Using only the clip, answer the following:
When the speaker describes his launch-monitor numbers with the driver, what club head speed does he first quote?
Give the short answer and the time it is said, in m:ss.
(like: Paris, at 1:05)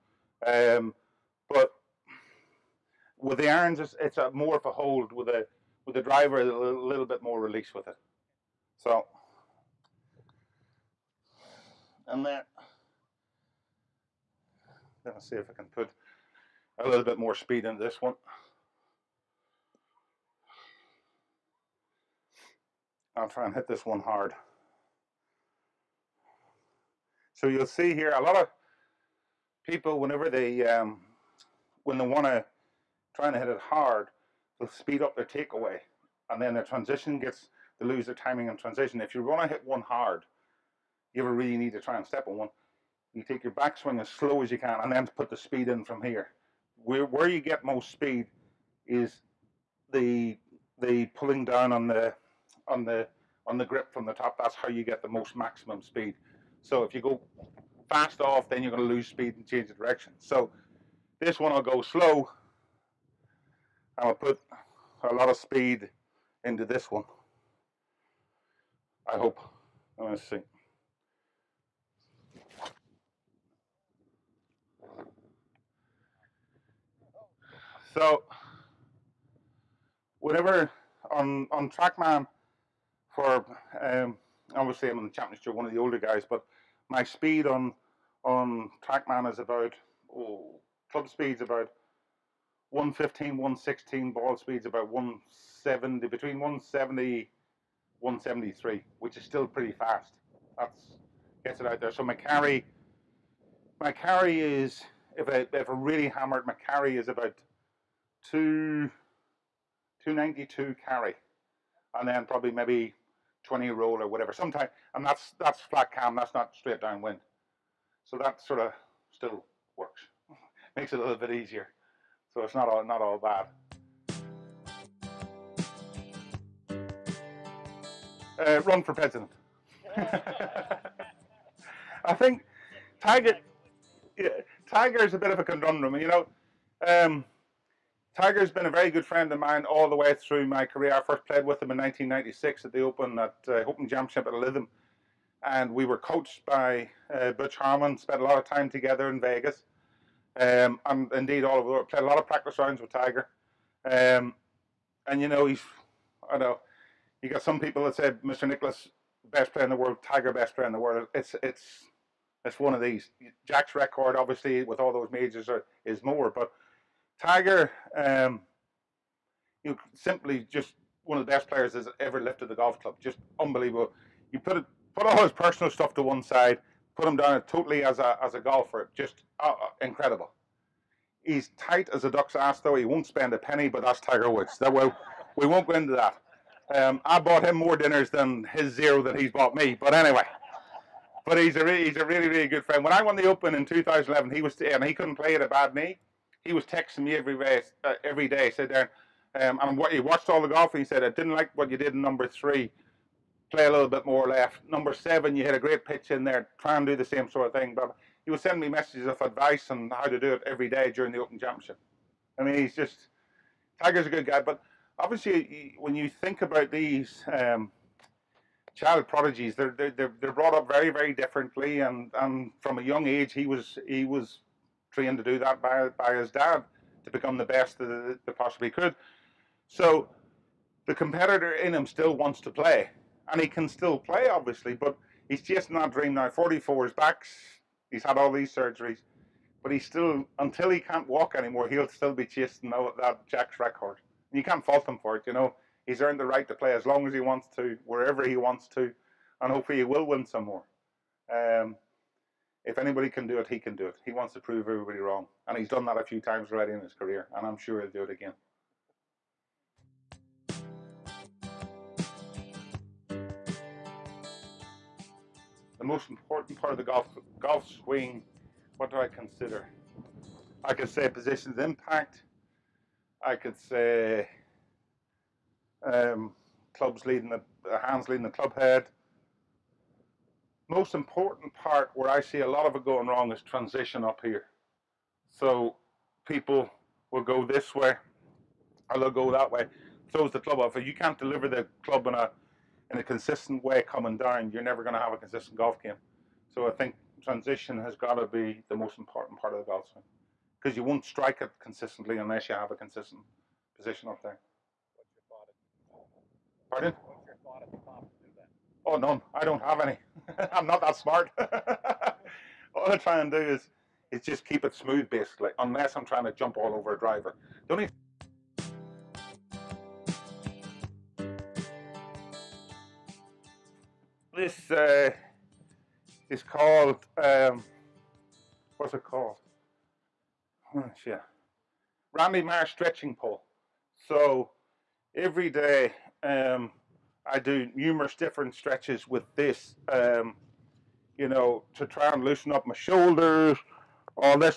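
115, at 1:31.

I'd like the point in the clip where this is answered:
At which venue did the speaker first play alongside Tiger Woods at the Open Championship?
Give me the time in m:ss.
2:24.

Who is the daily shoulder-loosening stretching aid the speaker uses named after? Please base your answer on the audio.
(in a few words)
Randy Myers.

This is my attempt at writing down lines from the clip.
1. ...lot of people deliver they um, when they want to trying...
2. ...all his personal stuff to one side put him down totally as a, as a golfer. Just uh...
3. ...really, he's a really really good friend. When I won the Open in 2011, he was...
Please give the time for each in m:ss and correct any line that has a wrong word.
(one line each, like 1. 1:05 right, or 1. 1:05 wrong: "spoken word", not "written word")
1. 0:28 wrong: "whenever", not "deliver"
2. 2:55 right
3. 3:11 right.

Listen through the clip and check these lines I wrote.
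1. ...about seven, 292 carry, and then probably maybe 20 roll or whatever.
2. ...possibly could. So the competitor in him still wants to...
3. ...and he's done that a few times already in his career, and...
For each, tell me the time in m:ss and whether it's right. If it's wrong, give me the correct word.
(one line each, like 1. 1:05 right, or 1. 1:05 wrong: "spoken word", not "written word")
1. 1:47 wrong: "two", not "seven"
2. 3:48 right
3. 4:15 right.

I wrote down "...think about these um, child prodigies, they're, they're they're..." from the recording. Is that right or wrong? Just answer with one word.
right.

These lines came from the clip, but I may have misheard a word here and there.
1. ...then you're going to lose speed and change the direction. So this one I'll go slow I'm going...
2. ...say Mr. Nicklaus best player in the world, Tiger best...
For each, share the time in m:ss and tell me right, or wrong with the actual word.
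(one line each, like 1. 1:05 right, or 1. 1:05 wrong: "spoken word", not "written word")
1. 0:58 right
2. 2:37 right.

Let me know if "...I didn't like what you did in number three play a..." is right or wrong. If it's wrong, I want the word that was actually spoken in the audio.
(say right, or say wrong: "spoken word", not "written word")
right.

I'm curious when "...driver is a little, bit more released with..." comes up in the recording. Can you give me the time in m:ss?
0:06.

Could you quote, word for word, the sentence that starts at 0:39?
If you want to hit one hard, you ever really need to try and step on one.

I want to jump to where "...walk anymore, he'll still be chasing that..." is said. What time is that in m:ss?
4:01.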